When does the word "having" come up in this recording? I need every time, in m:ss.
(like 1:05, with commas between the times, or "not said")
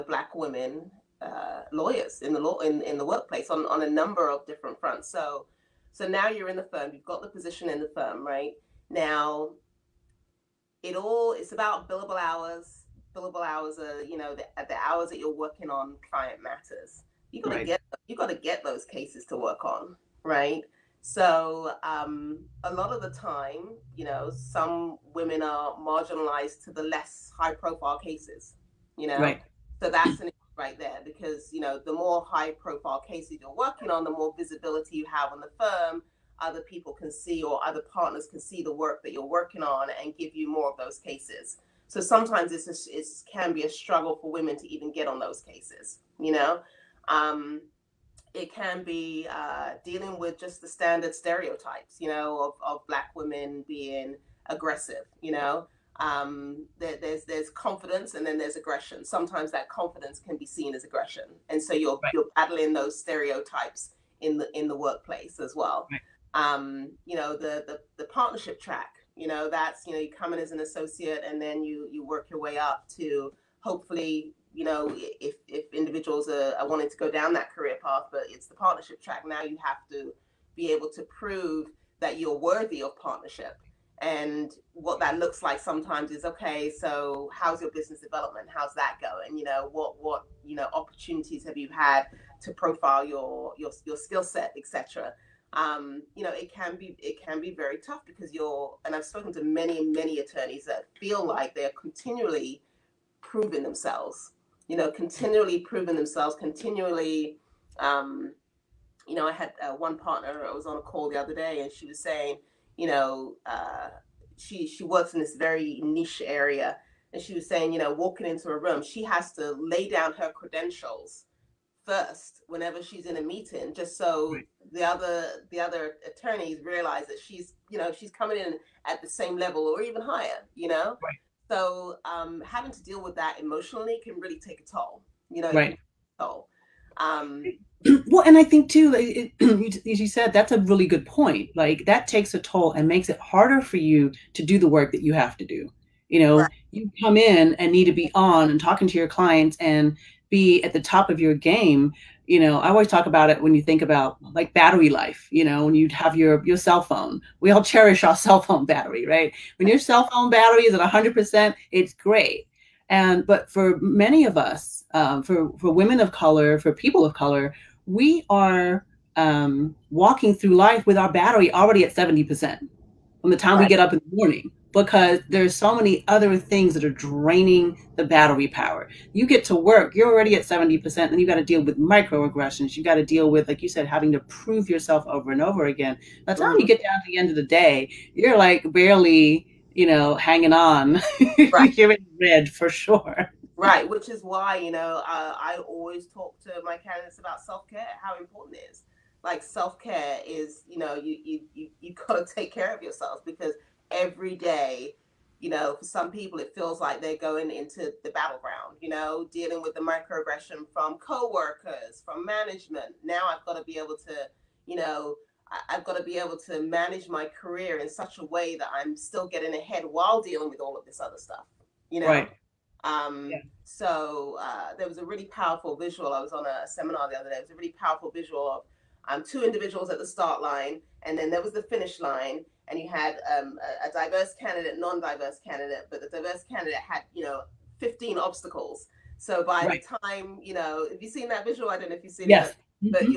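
2:12, 3:03.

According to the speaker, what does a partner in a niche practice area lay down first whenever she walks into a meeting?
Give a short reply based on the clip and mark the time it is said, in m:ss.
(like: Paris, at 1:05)
her credentials, at 2:00.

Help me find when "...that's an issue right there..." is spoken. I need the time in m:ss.
0:29.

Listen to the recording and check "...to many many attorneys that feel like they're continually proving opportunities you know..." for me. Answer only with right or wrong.
wrong.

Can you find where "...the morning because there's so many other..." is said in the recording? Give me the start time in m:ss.
2:54.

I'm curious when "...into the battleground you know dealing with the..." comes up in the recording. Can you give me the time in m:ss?
3:27.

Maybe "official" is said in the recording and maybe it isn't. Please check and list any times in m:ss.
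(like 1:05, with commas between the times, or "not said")
not said.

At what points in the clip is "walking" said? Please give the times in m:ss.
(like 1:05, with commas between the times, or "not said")
1:57, 2:49.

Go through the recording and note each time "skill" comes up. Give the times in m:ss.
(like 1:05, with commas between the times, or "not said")
1:33.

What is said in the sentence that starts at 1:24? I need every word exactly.
And what that looks like sometimes is okay.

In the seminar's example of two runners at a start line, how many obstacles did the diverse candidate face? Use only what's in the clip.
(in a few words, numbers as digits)
15.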